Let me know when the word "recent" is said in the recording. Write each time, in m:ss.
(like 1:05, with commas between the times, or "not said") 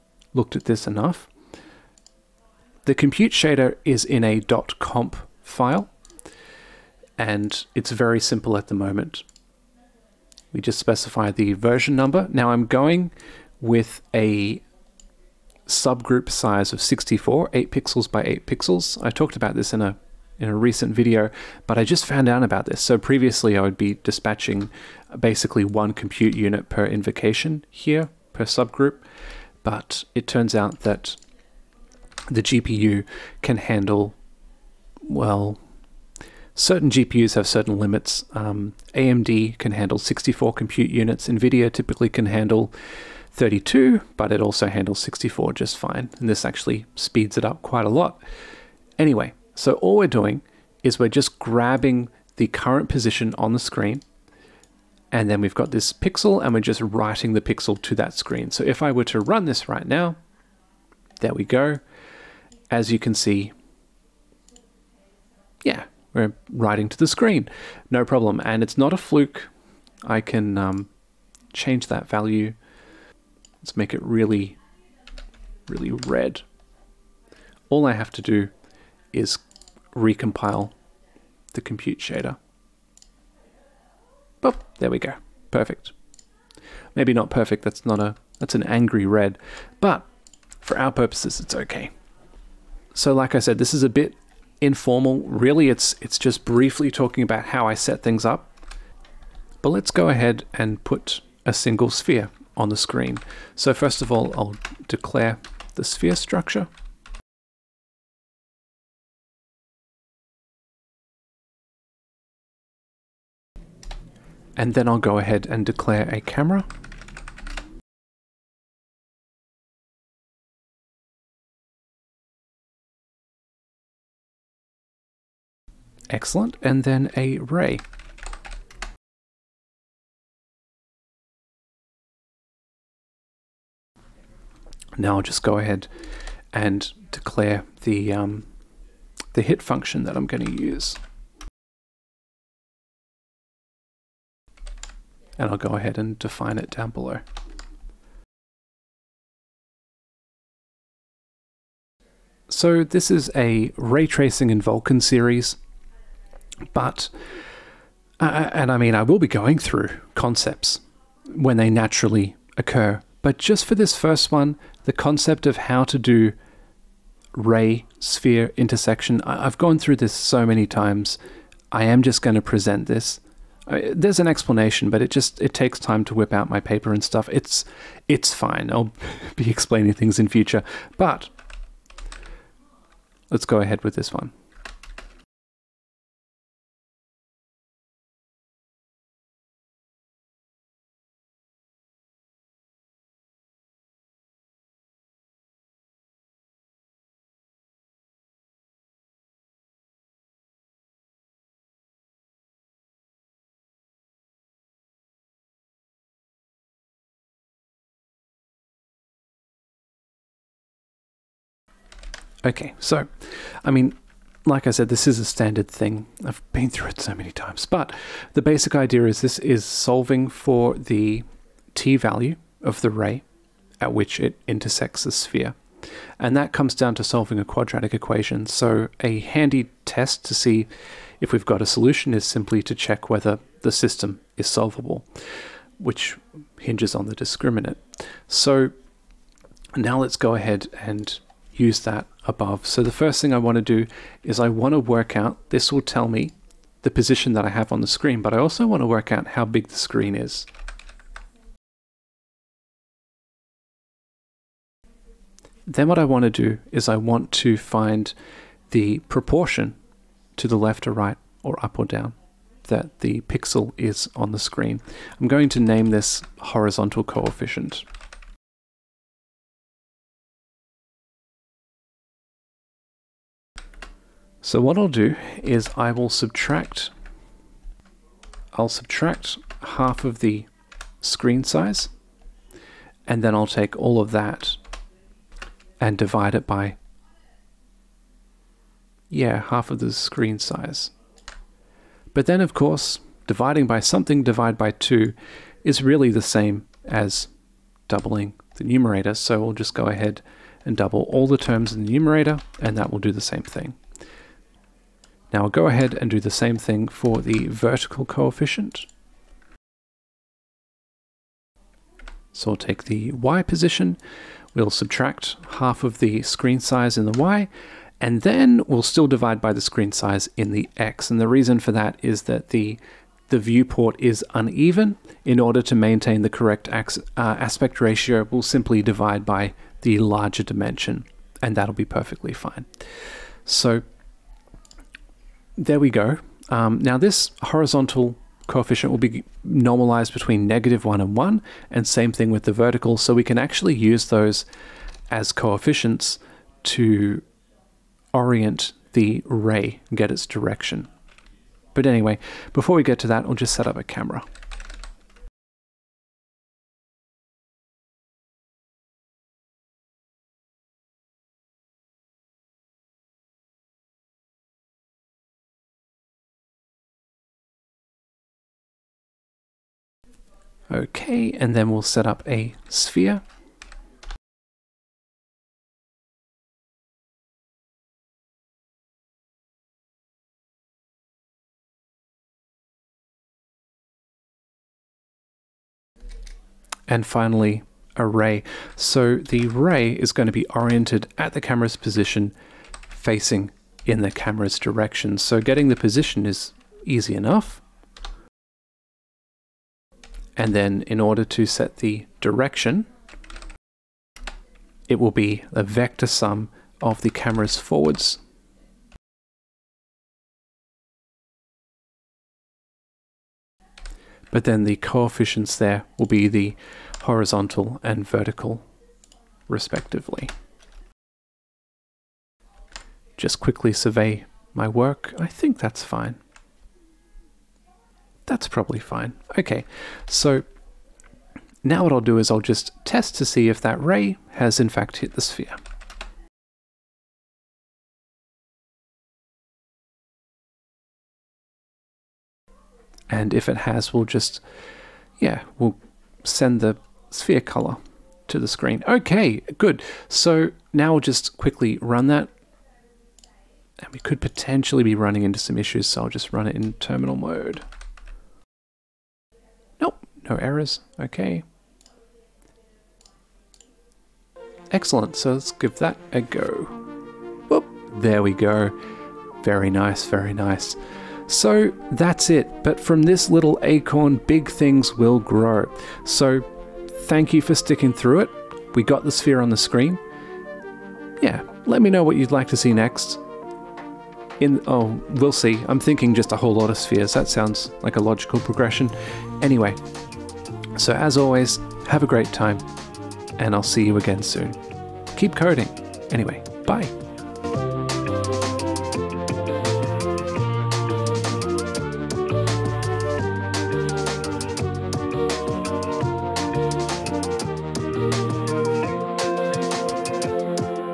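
0:20.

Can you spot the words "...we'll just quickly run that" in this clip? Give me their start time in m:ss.
7:30.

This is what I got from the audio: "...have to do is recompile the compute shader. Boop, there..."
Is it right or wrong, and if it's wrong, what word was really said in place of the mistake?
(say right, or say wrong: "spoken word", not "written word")
right.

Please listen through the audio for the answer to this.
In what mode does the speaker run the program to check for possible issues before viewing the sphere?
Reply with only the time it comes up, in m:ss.
7:36.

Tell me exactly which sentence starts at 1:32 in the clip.
So like I said, this is a bit informal.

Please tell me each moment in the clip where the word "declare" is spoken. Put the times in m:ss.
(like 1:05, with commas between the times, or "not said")
1:44, 1:55, 2:17.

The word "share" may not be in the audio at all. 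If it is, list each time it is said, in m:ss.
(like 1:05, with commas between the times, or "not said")
not said.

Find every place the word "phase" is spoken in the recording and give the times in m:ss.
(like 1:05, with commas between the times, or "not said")
not said.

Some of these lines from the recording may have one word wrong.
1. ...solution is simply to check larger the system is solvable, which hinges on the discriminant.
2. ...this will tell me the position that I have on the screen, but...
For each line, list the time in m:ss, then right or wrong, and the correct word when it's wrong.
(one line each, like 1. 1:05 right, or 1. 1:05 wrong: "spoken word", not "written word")
1. 3:51 wrong: "whether", not "larger"
2. 4:05 right.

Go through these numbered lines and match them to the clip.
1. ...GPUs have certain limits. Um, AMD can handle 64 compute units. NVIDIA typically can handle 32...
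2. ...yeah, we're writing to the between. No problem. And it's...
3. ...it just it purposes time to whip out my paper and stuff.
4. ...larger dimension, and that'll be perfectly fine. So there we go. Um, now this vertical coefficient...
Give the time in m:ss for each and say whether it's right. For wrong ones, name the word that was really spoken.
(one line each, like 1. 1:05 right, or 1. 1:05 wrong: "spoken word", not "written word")
1. 0:36 right
2. 1:05 wrong: "screen", not "between"
3. 2:55 wrong: "takes", not "purposes"
4. 5:29 wrong: "horizontal", not "vertical".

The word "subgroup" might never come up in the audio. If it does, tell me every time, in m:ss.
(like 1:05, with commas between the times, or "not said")
0:15, 0:28.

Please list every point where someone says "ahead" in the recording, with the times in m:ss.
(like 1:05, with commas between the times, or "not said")
1:40, 1:55, 2:15, 2:25, 3:03, 4:00, 4:59, 5:05.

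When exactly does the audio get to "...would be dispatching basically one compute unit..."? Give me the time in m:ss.
0:23.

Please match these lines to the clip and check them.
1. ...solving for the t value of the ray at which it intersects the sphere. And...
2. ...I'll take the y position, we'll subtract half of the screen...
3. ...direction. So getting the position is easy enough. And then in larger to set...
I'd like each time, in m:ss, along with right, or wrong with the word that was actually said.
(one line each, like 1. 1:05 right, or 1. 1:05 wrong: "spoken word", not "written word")
1. 3:39 right
2. 5:12 right
3. 6:34 wrong: "order", not "larger".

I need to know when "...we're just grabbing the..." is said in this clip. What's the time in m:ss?
0:50.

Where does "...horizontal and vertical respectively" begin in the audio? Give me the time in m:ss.
6:57.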